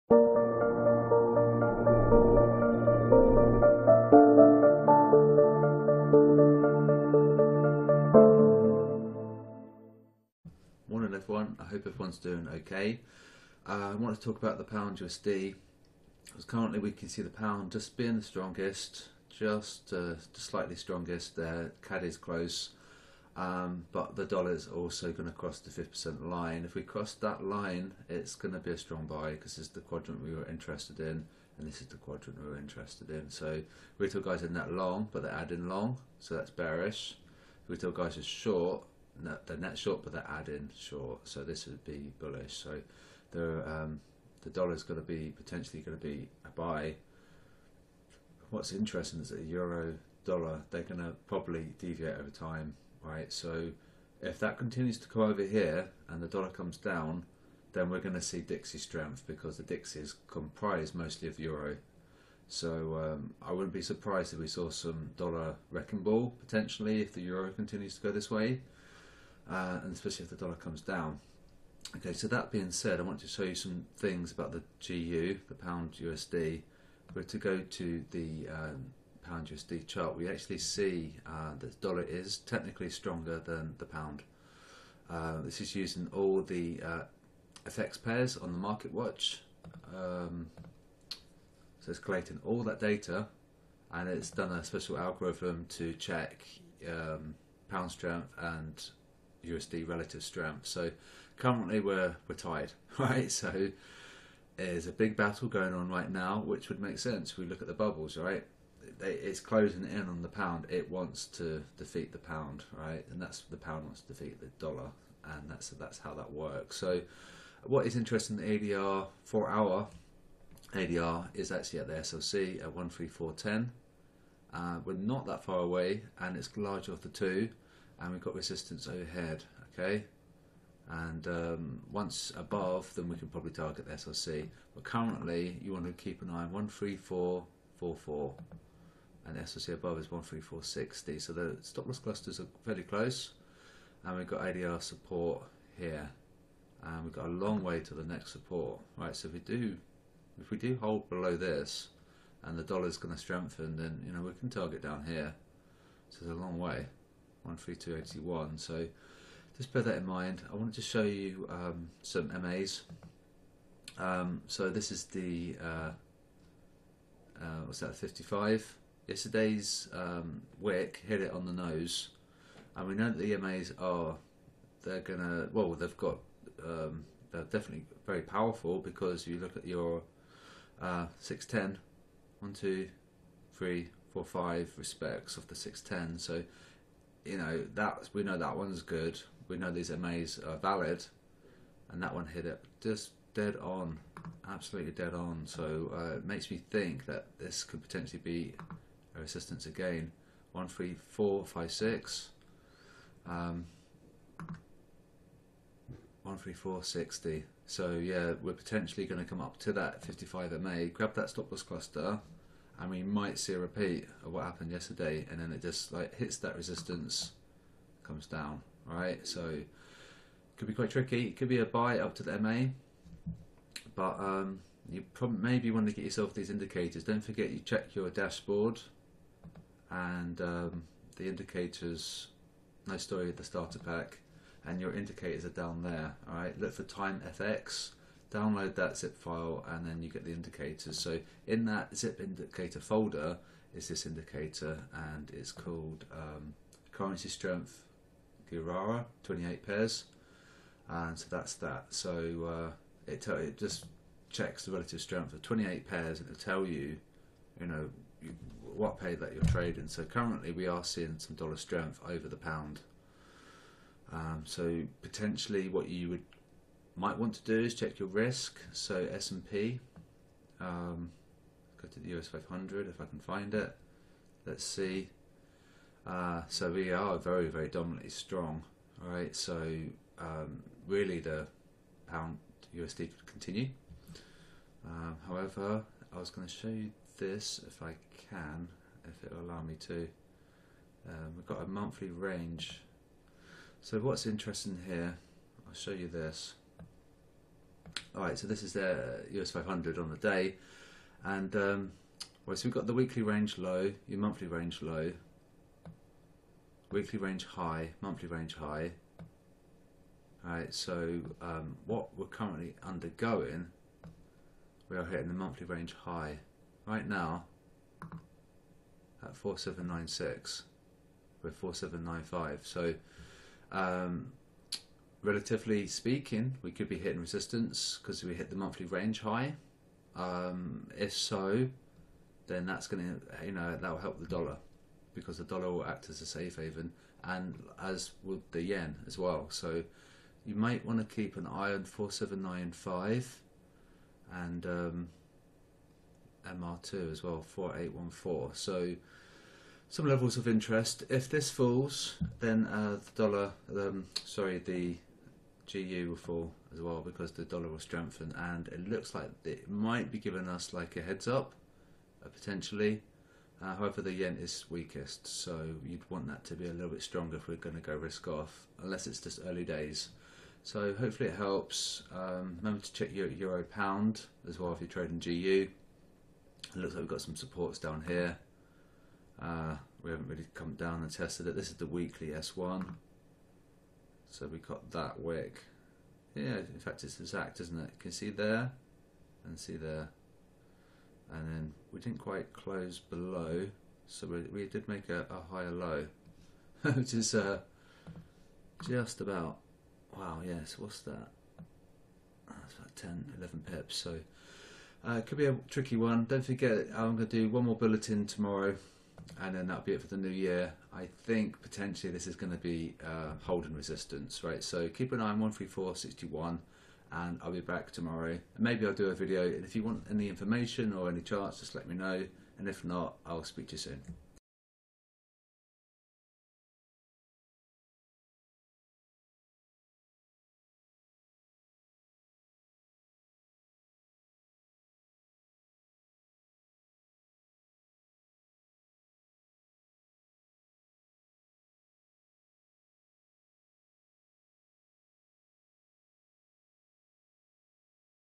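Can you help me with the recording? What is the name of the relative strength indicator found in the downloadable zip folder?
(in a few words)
currency strength Girara 28 pairs.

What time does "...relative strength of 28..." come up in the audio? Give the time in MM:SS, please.
04:14.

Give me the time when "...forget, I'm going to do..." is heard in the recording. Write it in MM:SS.
06:46.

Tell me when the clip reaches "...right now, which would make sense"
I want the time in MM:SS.
01:45.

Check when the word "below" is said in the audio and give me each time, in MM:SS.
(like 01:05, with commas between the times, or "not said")
02:31, 06:32.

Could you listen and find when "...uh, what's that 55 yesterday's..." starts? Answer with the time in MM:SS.
02:47.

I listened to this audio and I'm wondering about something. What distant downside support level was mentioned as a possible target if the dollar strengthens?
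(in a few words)
13281.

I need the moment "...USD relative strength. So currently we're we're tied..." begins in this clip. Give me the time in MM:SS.
01:39.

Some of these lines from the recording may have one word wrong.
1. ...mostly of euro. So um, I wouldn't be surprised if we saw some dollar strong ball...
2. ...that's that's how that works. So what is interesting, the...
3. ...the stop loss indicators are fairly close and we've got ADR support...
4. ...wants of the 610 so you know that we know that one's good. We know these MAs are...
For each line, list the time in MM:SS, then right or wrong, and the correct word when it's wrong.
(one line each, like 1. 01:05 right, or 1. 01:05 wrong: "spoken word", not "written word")
1. 01:00 wrong: "wrecking", not "strong"
2. 01:55 right
3. 02:21 wrong: "clusters", not "indicators"
4. 03:04 wrong: "respects", not "wants".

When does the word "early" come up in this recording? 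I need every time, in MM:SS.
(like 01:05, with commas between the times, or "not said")
06:09.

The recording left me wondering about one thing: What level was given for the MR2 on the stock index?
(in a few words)
4814.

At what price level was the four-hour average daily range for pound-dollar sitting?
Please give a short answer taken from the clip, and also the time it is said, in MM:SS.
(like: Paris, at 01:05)
13410, at 02:02.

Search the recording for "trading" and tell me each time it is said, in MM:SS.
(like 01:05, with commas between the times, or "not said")
04:19, 06:14.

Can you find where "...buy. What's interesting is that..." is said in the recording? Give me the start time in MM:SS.
00:46.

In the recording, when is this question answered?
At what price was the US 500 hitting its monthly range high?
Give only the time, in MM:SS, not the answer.
05:19.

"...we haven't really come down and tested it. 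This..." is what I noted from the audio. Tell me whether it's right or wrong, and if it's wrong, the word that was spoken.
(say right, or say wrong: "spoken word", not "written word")
right.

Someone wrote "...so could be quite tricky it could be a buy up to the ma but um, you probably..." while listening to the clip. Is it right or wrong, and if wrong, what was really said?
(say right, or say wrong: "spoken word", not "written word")
right.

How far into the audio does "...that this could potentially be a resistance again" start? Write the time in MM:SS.
03:17.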